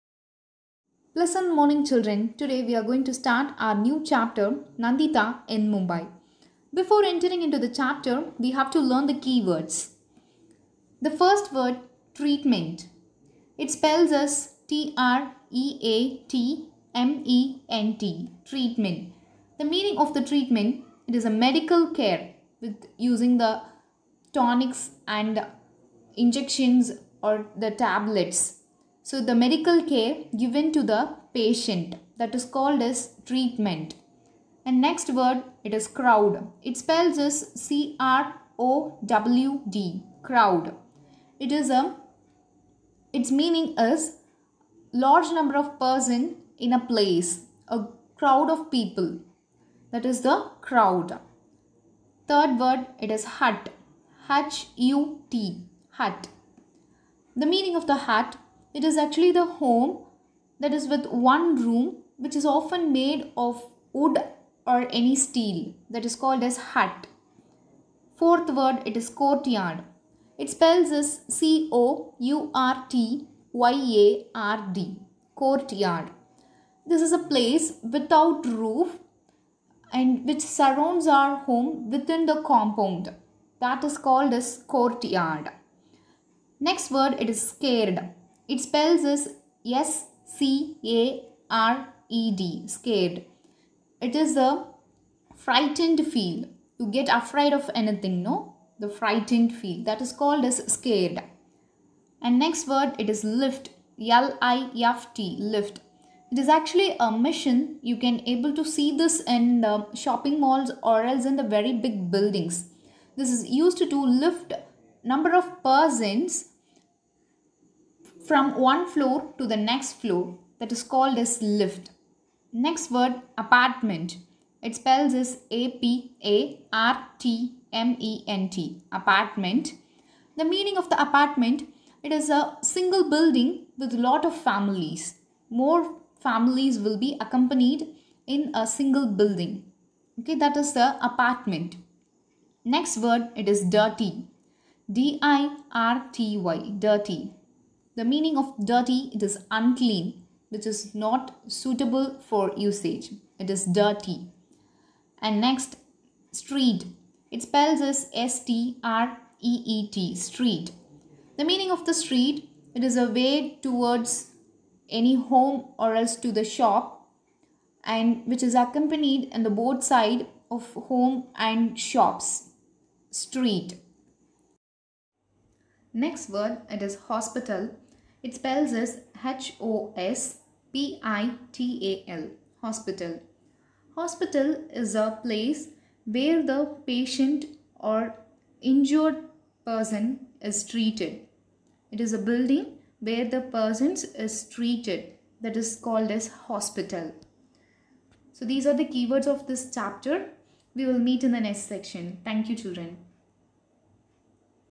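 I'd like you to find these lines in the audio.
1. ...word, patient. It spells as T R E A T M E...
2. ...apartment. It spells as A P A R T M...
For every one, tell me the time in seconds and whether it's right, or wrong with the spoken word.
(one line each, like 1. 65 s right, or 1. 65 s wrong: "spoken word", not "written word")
1. 11 s wrong: "treatment", not "patient"
2. 123 s right.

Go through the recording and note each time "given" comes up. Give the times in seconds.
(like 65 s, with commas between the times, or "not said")
30 s.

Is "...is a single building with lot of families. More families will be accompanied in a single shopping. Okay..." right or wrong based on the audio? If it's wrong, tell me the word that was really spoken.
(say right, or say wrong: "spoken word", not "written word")
wrong: "building", not "shopping".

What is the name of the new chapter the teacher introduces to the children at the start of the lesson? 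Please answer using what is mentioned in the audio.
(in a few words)
Nandita in Mumbai.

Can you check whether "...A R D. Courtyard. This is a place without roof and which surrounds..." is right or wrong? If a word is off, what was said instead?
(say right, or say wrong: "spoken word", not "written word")
right.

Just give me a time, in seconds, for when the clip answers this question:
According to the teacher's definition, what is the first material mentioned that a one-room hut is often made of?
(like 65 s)
63 s.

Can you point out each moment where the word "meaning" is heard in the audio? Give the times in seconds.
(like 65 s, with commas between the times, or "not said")
19 s, 43 s, 57 s, 130 s, 148 s, 161 s.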